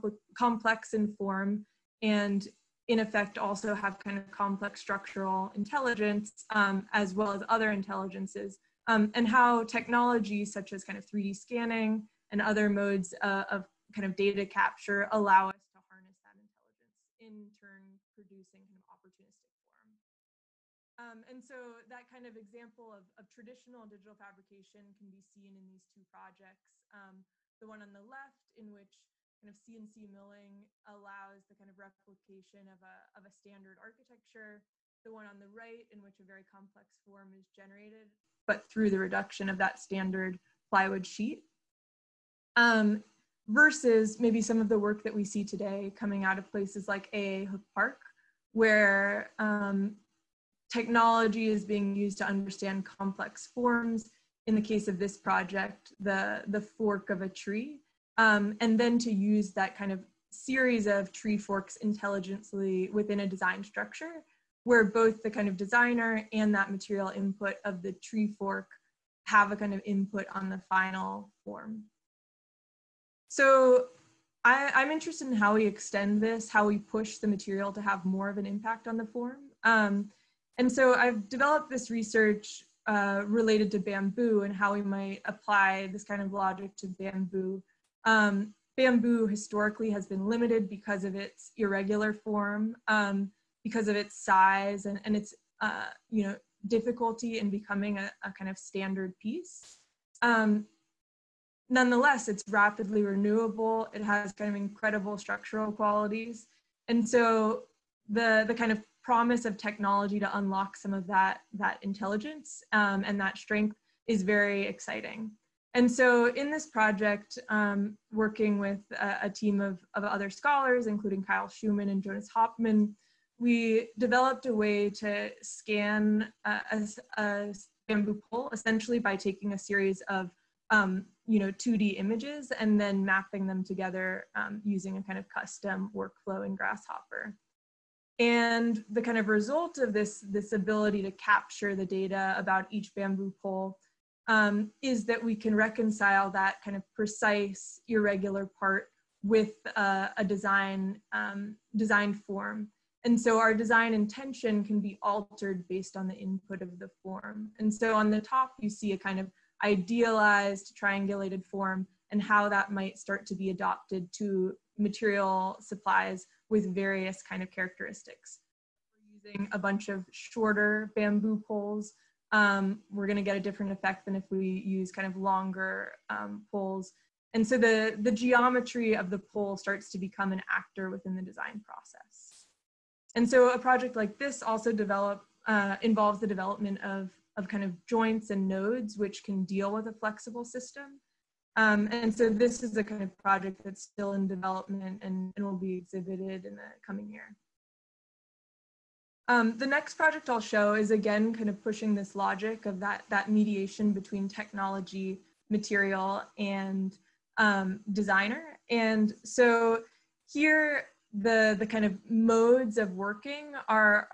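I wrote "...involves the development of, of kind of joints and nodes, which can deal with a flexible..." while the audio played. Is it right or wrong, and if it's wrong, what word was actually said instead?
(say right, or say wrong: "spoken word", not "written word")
right.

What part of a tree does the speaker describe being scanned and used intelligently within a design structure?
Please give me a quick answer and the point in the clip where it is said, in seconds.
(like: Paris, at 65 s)
The fork, at 56 s.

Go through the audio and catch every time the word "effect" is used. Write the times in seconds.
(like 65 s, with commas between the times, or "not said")
2 s, 173 s.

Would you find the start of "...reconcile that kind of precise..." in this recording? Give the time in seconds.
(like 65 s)
145 s.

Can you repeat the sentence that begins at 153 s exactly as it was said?
And so our design intention can be altered based on the input of the form.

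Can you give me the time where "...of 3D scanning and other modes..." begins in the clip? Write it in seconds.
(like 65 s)
10 s.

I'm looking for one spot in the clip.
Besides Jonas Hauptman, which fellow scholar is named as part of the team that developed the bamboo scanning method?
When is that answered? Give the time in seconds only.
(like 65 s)
121 s.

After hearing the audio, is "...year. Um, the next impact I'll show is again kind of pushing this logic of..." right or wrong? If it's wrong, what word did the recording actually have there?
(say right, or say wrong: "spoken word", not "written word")
wrong: "project", not "impact".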